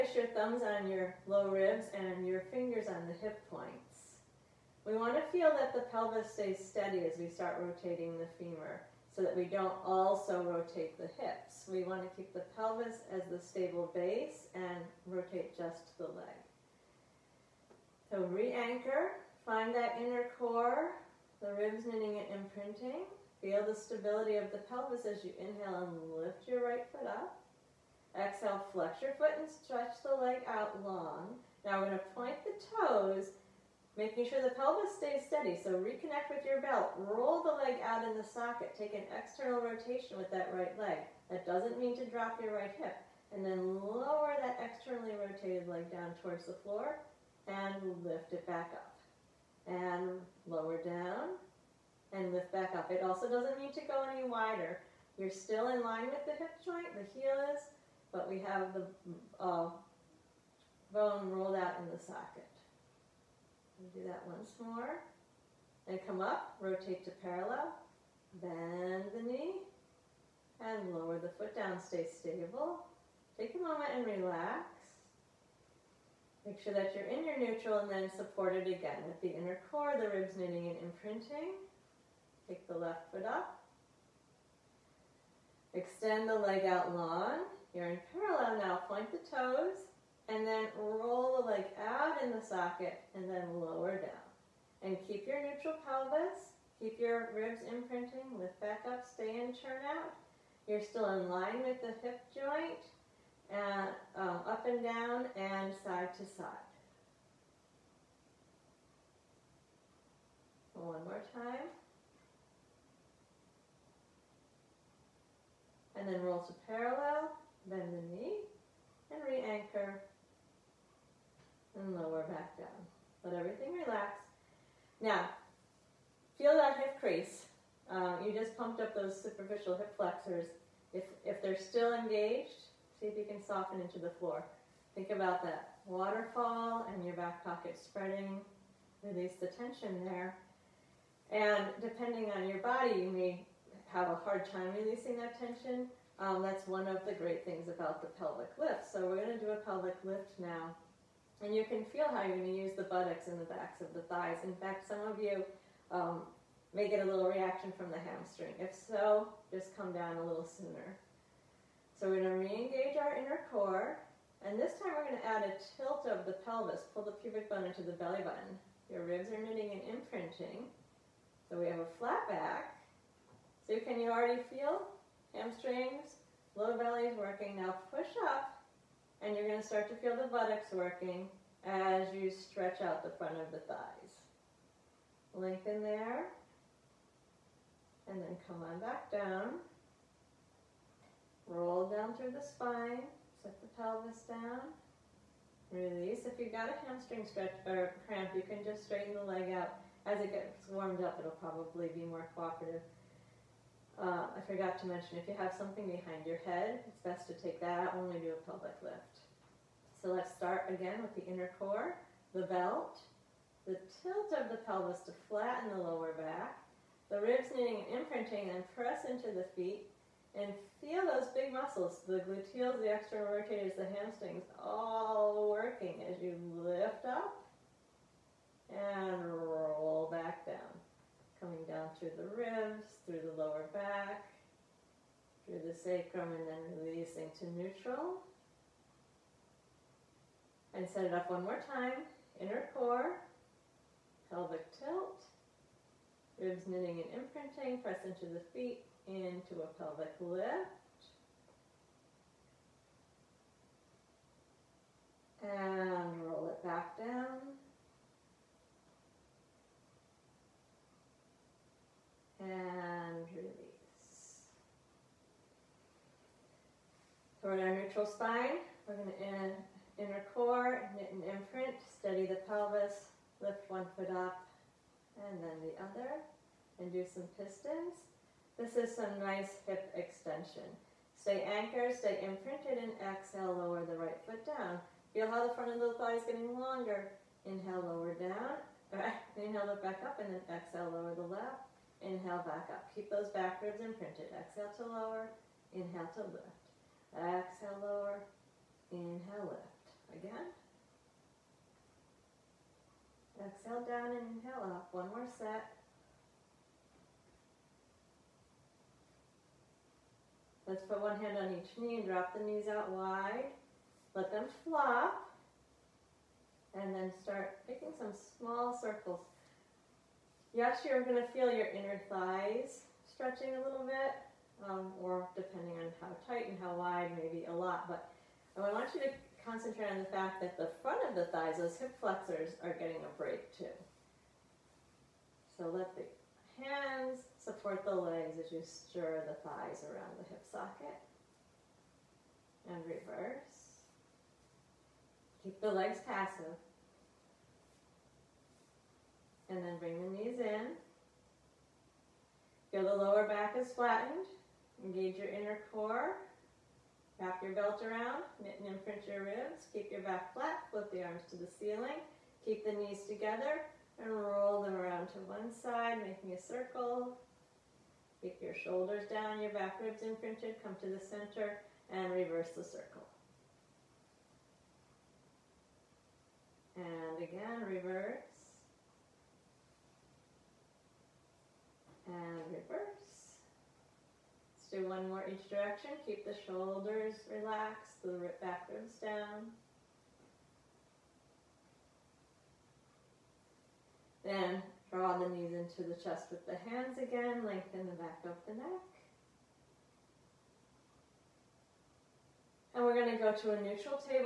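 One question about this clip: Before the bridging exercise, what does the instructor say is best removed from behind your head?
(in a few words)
Something behind your head.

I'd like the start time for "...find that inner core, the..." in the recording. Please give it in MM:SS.
00:19.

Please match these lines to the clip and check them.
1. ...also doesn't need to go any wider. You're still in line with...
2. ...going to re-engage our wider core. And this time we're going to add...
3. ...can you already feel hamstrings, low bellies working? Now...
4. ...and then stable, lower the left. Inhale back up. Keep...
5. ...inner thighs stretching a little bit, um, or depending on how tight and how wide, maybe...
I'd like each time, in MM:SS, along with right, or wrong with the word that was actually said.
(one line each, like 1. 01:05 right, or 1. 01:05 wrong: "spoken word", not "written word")
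1. 00:53 right
2. 02:42 wrong: "inner", not "wider"
3. 02:53 right
4. 04:50 wrong: "exhale", not "stable"
5. 05:21 right.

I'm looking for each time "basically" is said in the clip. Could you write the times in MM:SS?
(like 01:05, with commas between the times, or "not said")
not said.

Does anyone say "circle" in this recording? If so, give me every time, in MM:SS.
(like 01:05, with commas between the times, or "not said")
05:18, 06:06, 06:12.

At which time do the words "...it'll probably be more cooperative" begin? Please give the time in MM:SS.
03:21.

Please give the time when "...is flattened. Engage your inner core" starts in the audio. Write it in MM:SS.
05:53.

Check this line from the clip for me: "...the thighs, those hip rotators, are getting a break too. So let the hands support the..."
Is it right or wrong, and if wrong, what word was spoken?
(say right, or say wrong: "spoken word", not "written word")
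wrong: "flexors", not "rotators".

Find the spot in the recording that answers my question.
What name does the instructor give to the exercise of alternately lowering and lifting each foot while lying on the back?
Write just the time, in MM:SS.
04:37.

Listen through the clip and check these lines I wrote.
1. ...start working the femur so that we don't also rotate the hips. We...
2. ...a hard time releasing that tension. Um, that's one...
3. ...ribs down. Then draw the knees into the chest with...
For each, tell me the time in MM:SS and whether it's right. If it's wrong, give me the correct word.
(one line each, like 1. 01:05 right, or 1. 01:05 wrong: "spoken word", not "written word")
1. 00:07 wrong: "rotating", not "working"
2. 02:24 right
3. 06:28 right.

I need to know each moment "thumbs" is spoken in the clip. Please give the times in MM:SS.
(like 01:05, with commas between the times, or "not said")
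00:00.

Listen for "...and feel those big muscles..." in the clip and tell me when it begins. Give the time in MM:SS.
03:40.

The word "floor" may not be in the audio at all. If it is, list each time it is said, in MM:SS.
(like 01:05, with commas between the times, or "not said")
00:46, 02:14.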